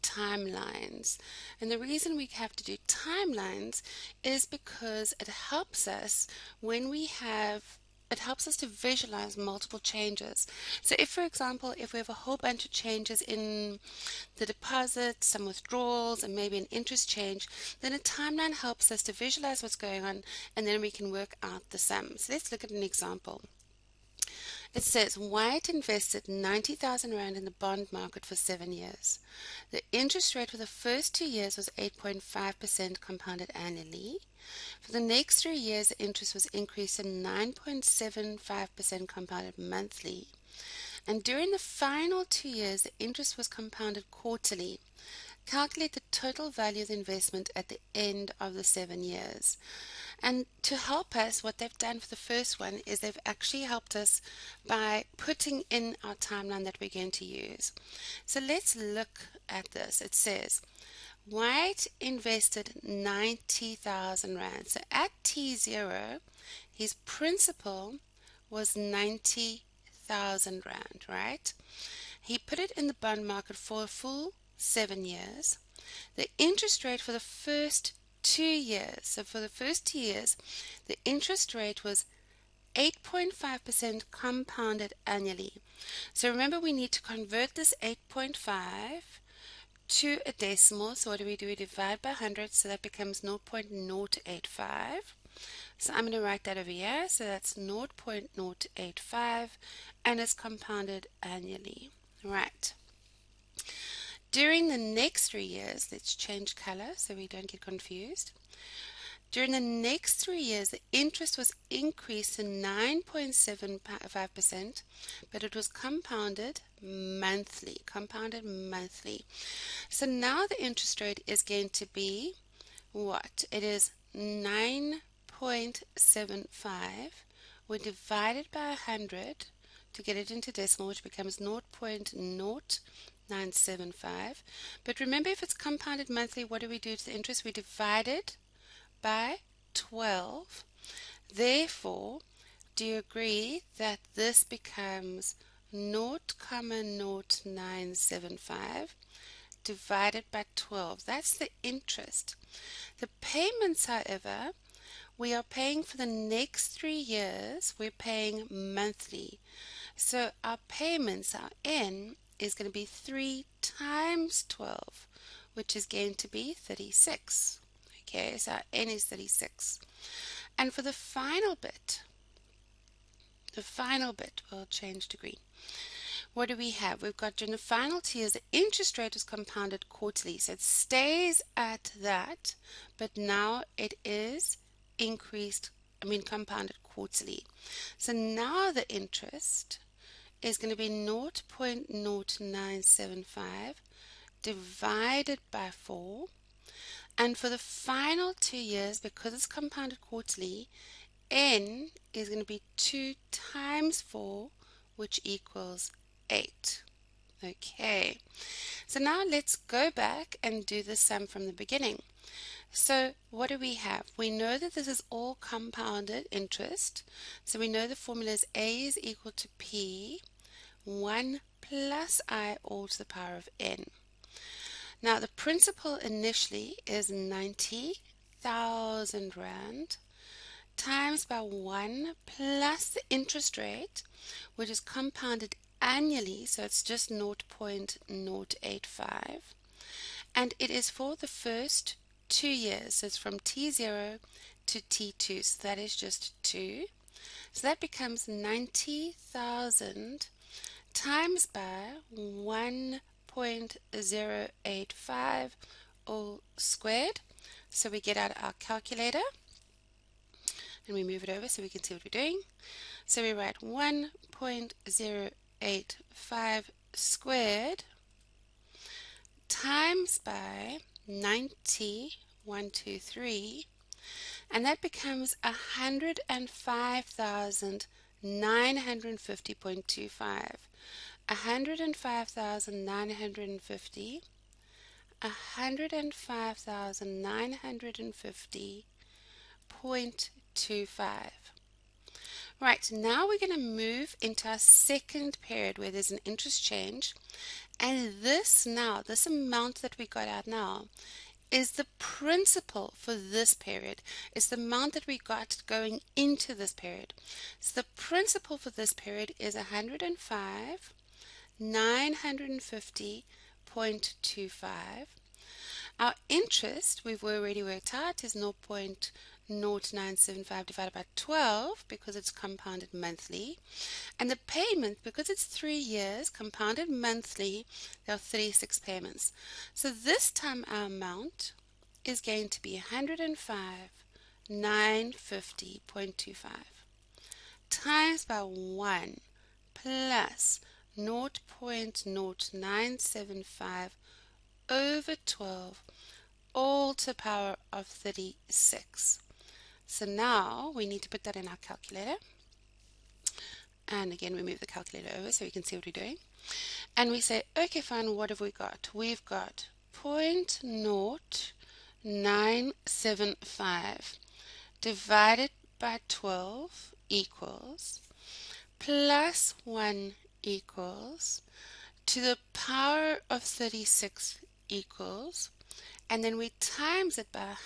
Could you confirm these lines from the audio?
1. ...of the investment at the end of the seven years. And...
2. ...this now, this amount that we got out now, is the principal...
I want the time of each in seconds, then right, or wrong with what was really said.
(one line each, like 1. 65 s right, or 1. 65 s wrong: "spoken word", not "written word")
1. 46 s right
2. 298 s right.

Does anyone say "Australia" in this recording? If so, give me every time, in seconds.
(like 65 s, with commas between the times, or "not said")
not said.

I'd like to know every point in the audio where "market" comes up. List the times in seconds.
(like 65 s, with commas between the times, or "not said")
27 s, 73 s.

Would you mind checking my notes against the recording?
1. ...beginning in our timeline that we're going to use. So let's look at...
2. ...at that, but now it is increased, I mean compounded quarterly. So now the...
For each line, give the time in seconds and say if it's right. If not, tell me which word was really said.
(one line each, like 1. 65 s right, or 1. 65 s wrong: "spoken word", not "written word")
1. 55 s wrong: "putting", not "beginning"
2. 181 s right.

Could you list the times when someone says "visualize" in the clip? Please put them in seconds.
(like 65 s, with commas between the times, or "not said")
8 s, 19 s.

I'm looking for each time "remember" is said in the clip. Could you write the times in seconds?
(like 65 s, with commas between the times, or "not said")
86 s, 134 s.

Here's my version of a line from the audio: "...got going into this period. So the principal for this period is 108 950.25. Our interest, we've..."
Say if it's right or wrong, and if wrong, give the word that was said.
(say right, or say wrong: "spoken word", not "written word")
wrong: "105", not "108".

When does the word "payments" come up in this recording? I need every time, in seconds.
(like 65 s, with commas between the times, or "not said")
153 s, 160 s, 324 s, 328 s.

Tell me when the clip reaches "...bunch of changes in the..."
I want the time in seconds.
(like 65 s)
12 s.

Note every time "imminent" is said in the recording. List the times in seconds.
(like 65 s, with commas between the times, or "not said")
not said.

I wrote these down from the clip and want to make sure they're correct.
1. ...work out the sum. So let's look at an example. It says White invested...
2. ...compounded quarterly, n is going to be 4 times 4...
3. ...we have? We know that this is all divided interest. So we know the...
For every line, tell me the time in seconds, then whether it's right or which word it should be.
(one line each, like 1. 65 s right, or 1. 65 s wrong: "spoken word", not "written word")
1. 21 s right
2. 199 s wrong: "2", not "4"
3. 213 s wrong: "compounded", not "divided".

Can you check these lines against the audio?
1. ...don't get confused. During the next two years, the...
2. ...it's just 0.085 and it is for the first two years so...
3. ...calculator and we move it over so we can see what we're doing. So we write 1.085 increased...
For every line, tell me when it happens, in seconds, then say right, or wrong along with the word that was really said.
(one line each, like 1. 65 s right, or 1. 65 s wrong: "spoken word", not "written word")
1. 107 s wrong: "three", not "two"
2. 236 s right
3. 258 s wrong: "squared", not "increased".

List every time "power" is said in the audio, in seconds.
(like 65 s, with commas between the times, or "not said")
223 s, 347 s.